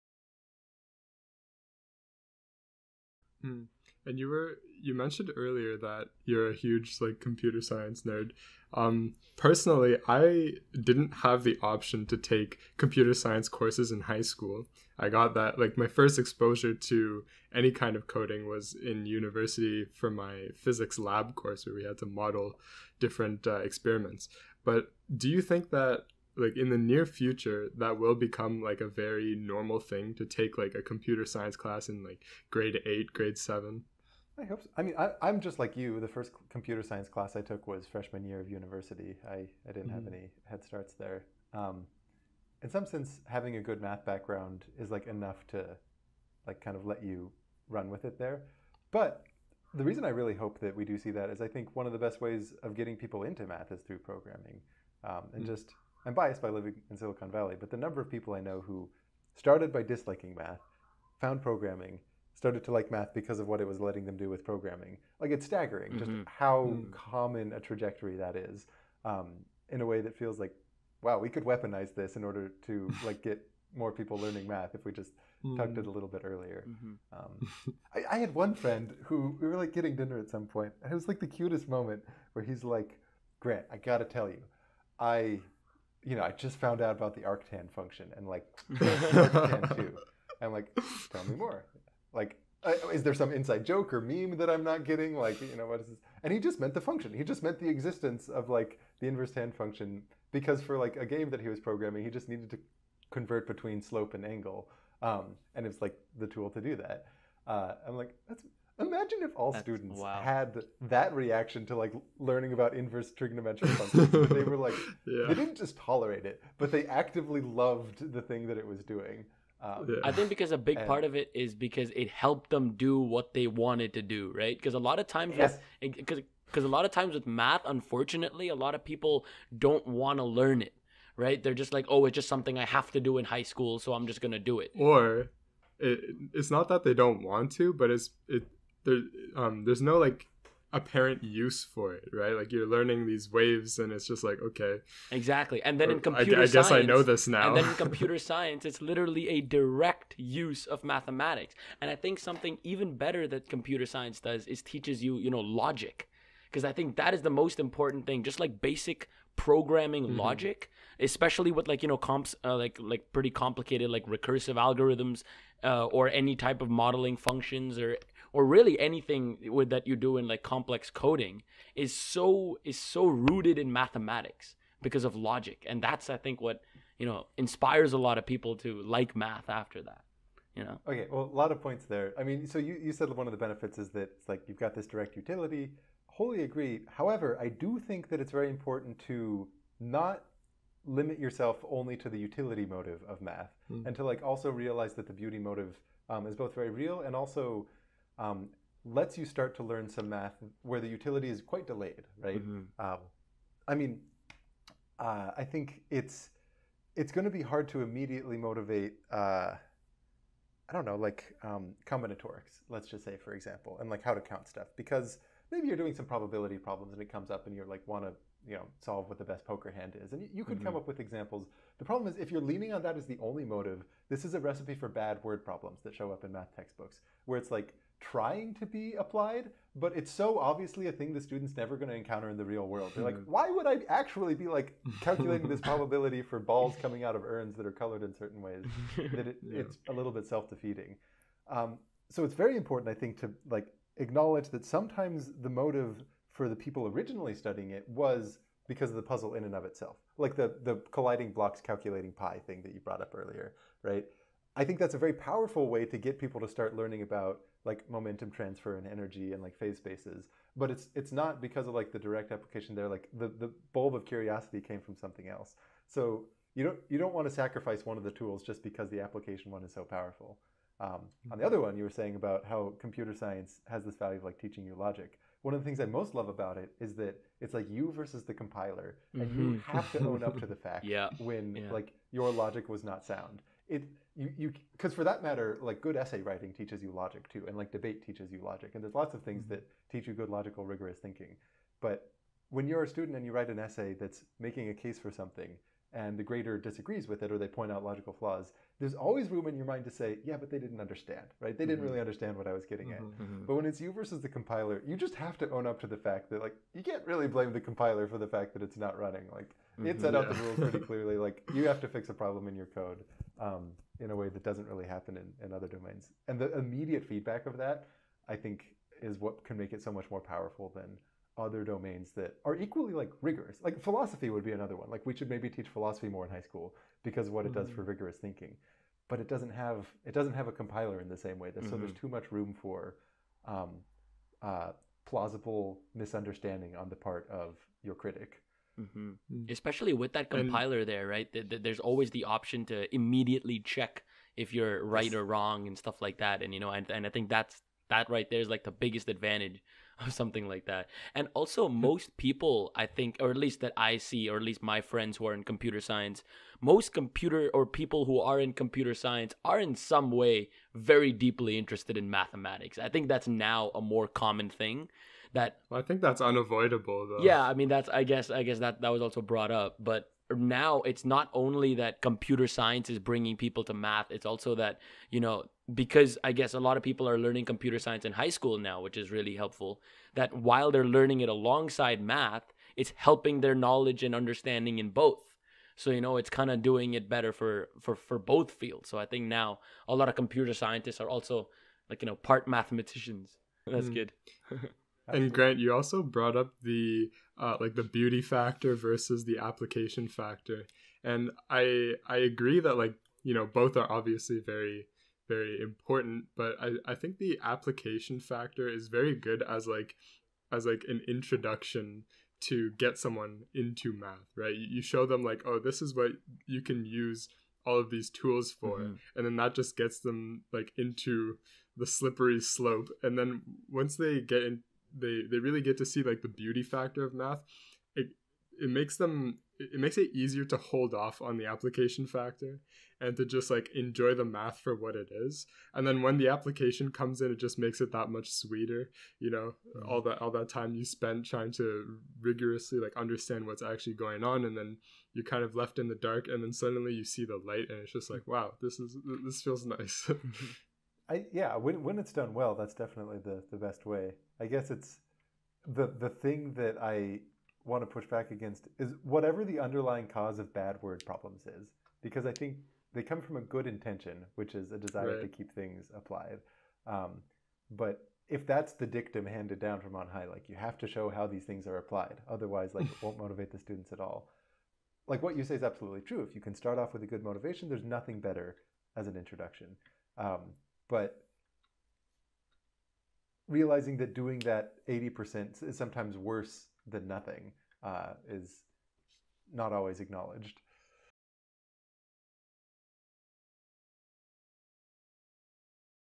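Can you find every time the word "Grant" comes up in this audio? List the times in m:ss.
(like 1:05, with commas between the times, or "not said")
1:23, 6:35.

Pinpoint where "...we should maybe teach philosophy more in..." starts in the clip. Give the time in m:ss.
5:25.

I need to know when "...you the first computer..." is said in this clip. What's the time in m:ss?
0:35.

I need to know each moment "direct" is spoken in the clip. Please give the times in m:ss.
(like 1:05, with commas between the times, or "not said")
2:29, 3:04, 4:21.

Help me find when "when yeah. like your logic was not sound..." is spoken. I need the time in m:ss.
4:41.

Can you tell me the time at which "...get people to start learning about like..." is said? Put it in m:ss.
4:15.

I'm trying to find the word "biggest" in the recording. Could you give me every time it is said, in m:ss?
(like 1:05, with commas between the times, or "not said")
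5:48.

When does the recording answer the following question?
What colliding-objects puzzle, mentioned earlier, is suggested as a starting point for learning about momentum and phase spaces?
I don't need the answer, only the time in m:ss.
4:11.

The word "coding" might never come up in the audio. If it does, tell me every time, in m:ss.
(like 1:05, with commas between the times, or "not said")
0:18, 2:50.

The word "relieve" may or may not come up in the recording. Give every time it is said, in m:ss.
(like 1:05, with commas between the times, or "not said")
not said.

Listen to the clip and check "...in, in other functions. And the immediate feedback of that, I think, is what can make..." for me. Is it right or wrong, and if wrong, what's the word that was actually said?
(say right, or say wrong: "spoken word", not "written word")
wrong: "domains", not "functions".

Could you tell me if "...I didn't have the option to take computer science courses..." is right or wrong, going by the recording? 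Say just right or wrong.
right.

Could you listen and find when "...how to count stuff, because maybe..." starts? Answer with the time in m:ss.
3:34.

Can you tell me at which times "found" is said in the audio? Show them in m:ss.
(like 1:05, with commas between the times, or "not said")
1:01, 1:26.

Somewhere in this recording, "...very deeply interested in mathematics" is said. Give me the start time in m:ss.
6:00.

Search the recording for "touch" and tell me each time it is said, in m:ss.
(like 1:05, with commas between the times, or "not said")
not said.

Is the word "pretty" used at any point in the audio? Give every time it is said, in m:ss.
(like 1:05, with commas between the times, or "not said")
2:43, 5:10.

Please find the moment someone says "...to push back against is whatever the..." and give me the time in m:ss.
7:37.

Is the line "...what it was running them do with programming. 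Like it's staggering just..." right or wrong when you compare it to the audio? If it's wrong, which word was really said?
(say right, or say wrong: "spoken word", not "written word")
wrong: "letting", not "running".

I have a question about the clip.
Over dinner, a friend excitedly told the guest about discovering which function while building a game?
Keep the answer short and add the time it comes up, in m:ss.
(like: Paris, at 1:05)
arctan2, at 1:28.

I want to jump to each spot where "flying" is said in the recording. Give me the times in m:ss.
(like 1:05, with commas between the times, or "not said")
not said.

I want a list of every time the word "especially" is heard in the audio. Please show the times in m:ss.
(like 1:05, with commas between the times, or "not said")
2:41, 5:39.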